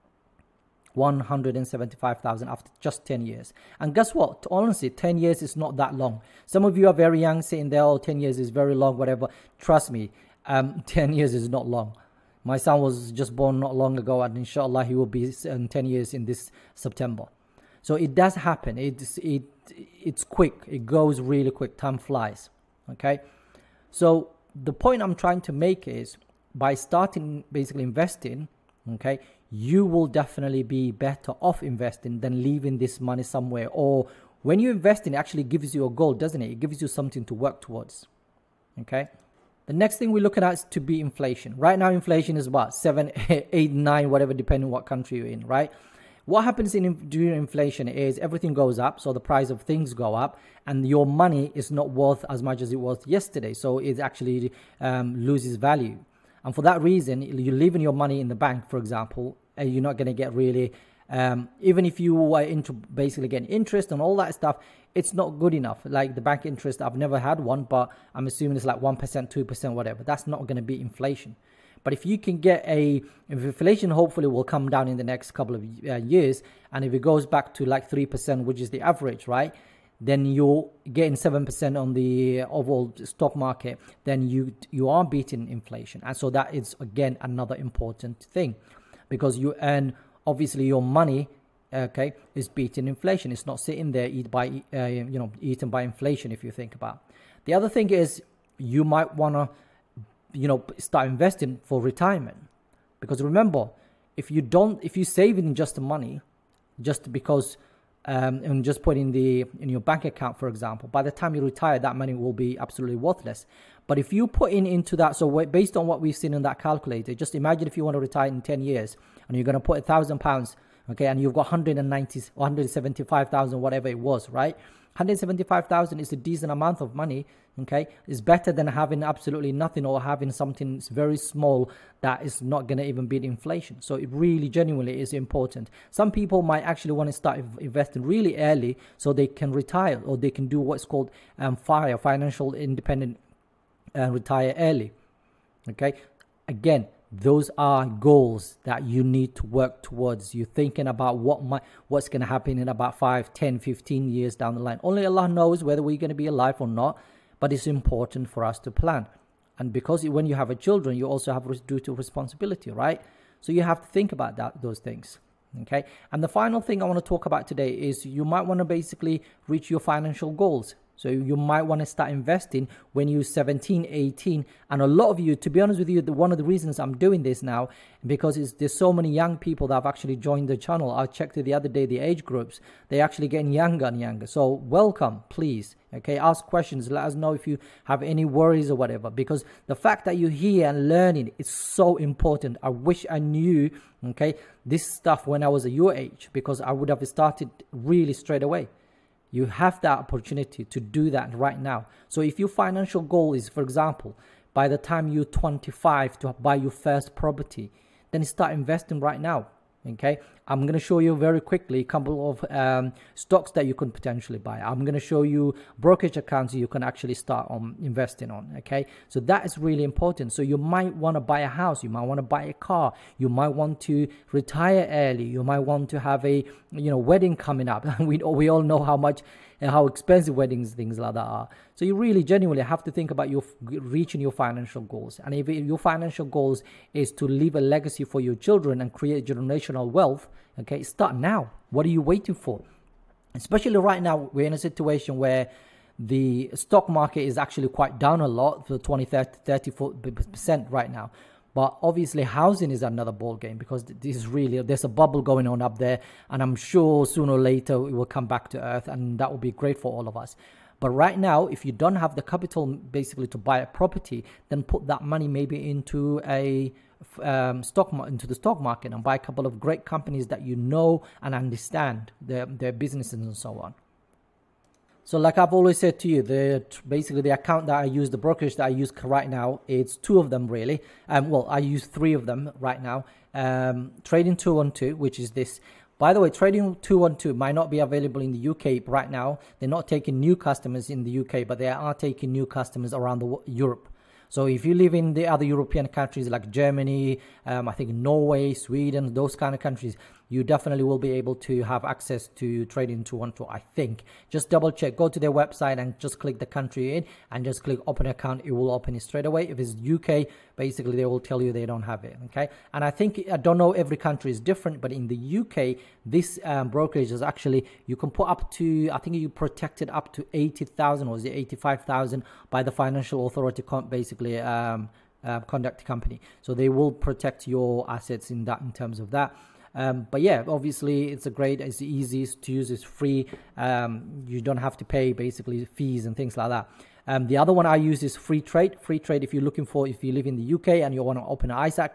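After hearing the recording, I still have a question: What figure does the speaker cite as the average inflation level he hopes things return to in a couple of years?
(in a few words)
3%.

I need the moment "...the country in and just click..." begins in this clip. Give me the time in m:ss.
5:06.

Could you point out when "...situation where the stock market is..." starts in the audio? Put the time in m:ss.
4:04.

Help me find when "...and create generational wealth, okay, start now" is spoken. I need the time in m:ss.
3:58.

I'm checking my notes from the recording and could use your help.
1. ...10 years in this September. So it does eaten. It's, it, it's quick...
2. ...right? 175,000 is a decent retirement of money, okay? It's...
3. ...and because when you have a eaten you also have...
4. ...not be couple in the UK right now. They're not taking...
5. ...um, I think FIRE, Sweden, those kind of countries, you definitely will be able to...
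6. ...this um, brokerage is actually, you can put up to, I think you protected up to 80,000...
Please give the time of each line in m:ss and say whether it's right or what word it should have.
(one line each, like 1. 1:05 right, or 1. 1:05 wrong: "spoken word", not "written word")
1. 0:15 wrong: "happen", not "eaten"
2. 2:04 wrong: "amount", not "retirement"
3. 2:39 wrong: "children", not "eaten"
4. 4:47 wrong: "available", not "couple"
5. 4:57 wrong: "Norway", not "FIRE"
6. 5:16 right.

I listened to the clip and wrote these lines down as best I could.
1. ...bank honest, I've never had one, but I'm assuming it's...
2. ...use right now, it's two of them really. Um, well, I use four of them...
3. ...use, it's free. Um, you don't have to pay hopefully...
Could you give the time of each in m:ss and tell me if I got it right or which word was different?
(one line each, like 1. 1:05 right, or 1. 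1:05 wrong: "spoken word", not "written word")
1. 1:06 wrong: "interest", not "honest"
2. 4:38 wrong: "three", not "four"
3. 5:32 wrong: "basically", not "hopefully".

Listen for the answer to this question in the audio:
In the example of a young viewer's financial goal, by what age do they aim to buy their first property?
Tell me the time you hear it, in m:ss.
3:25.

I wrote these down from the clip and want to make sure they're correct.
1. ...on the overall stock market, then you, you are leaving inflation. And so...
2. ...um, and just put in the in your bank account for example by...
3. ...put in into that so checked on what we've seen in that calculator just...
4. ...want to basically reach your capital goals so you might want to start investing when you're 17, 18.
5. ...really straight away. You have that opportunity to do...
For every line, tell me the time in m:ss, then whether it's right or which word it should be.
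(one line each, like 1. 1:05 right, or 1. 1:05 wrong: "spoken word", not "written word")
1. 1:21 wrong: "beating", not "leaving"
2. 1:48 right
3. 1:54 wrong: "based", not "checked"
4. 2:48 wrong: "financial", not "capital"
5. 3:17 right.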